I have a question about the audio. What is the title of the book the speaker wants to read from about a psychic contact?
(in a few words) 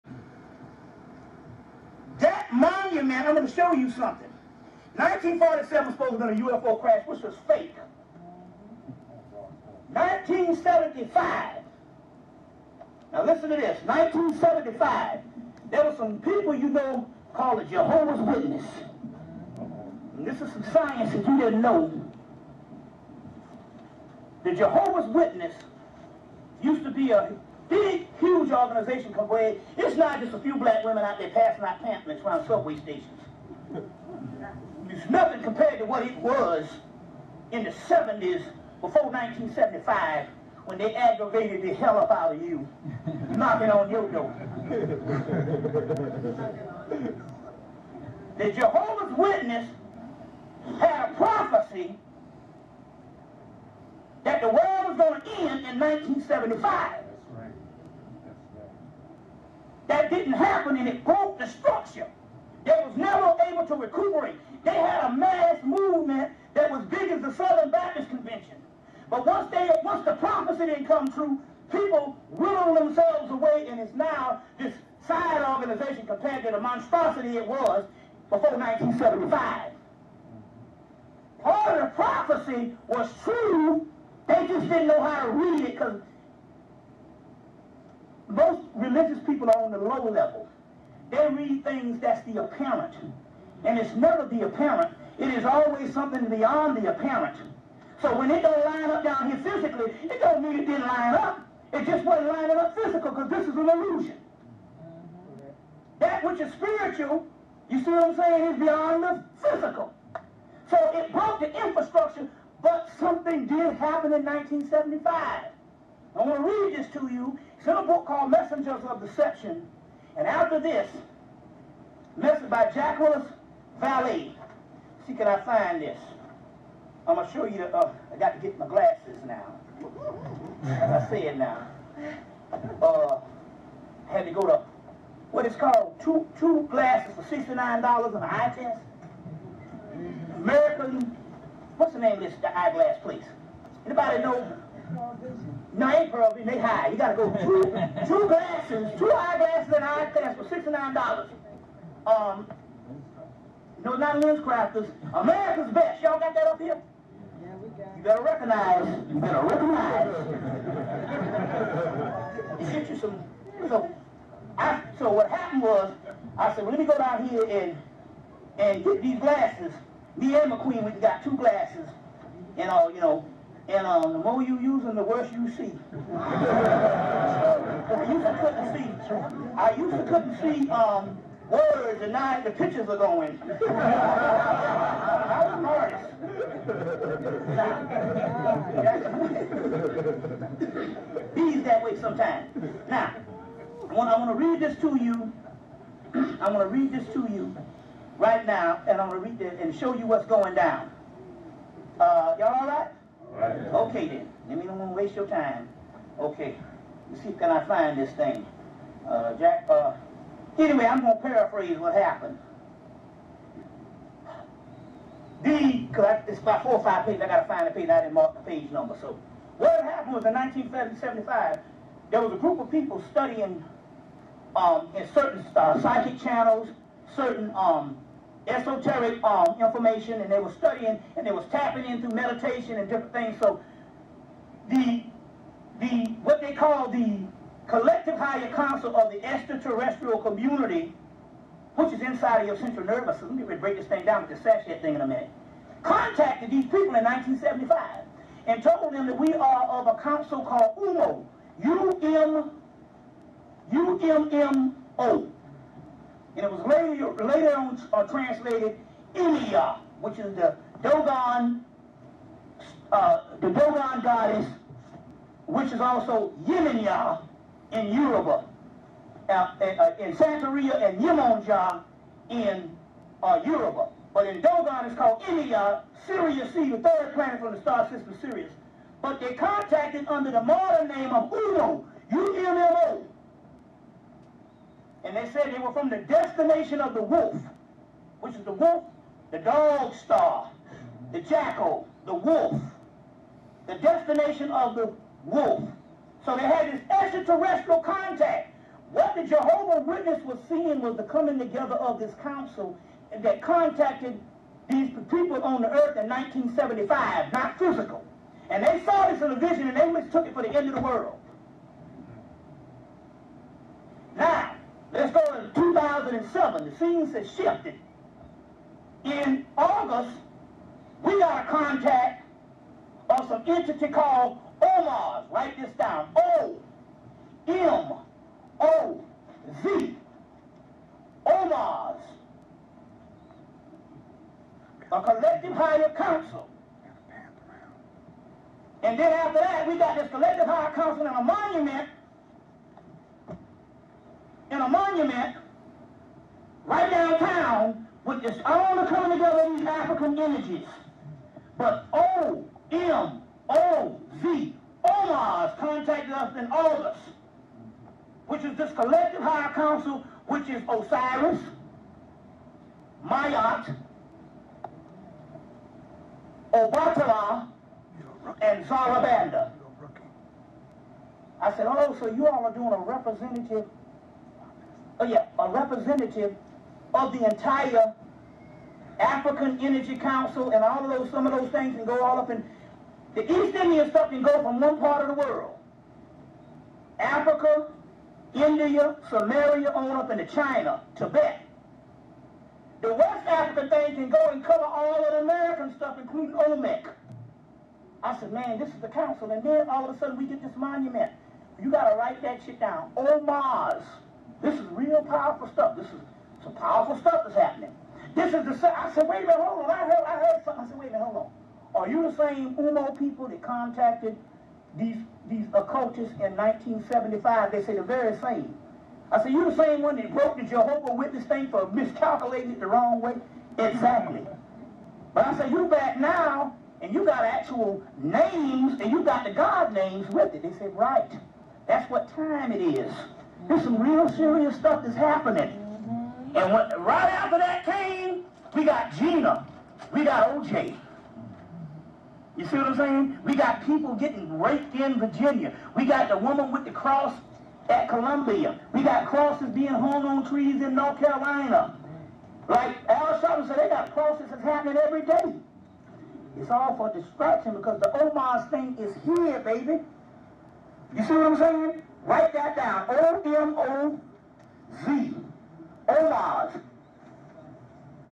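Messengers of Deception.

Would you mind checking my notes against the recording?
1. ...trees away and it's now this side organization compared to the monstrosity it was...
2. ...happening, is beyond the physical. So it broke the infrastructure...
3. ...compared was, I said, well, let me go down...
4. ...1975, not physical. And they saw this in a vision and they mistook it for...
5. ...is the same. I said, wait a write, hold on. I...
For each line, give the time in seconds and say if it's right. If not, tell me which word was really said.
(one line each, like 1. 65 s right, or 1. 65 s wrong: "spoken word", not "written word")
1. 72 s wrong: "themselves", not "trees"
2. 108 s wrong: "saying", not "happening"
3. 165 s wrong: "happened", not "compared"
4. 306 s right
5. 408 s wrong: "minute", not "write".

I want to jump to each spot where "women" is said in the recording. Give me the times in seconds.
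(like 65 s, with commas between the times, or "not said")
30 s.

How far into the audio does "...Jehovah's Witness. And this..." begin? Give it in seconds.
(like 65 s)
17 s.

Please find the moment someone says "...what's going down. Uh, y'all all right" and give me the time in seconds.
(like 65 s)
200 s.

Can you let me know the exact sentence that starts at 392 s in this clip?
The West African thing can go and cover all of the American stuff, including Olmec.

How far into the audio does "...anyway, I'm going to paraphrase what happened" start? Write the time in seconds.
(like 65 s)
210 s.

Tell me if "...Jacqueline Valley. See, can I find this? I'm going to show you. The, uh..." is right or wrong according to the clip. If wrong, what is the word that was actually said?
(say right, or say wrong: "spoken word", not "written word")
right.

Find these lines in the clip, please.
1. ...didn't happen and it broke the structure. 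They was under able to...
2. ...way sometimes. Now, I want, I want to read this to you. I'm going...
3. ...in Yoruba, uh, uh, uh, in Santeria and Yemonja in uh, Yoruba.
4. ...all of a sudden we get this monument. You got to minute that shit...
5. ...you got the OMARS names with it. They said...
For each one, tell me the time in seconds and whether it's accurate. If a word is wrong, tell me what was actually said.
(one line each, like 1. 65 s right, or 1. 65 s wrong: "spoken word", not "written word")
1. 60 s wrong: "never", not "under"
2. 191 s right
3. 267 s right
4. 399 s wrong: "write", not "minute"
5. 428 s wrong: "God", not "OMARS".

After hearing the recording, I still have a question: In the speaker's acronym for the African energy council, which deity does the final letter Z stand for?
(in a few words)
Zarabanda.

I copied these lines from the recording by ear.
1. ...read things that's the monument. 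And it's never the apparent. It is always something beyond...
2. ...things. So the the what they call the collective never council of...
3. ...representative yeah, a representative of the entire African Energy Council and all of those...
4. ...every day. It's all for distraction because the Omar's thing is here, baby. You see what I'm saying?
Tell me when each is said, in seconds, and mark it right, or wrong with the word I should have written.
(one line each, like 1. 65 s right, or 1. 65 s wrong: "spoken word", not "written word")
1. 91 s wrong: "apparent", not "monument"
2. 233 s wrong: "higher", not "never"
3. 372 s right
4. 454 s right.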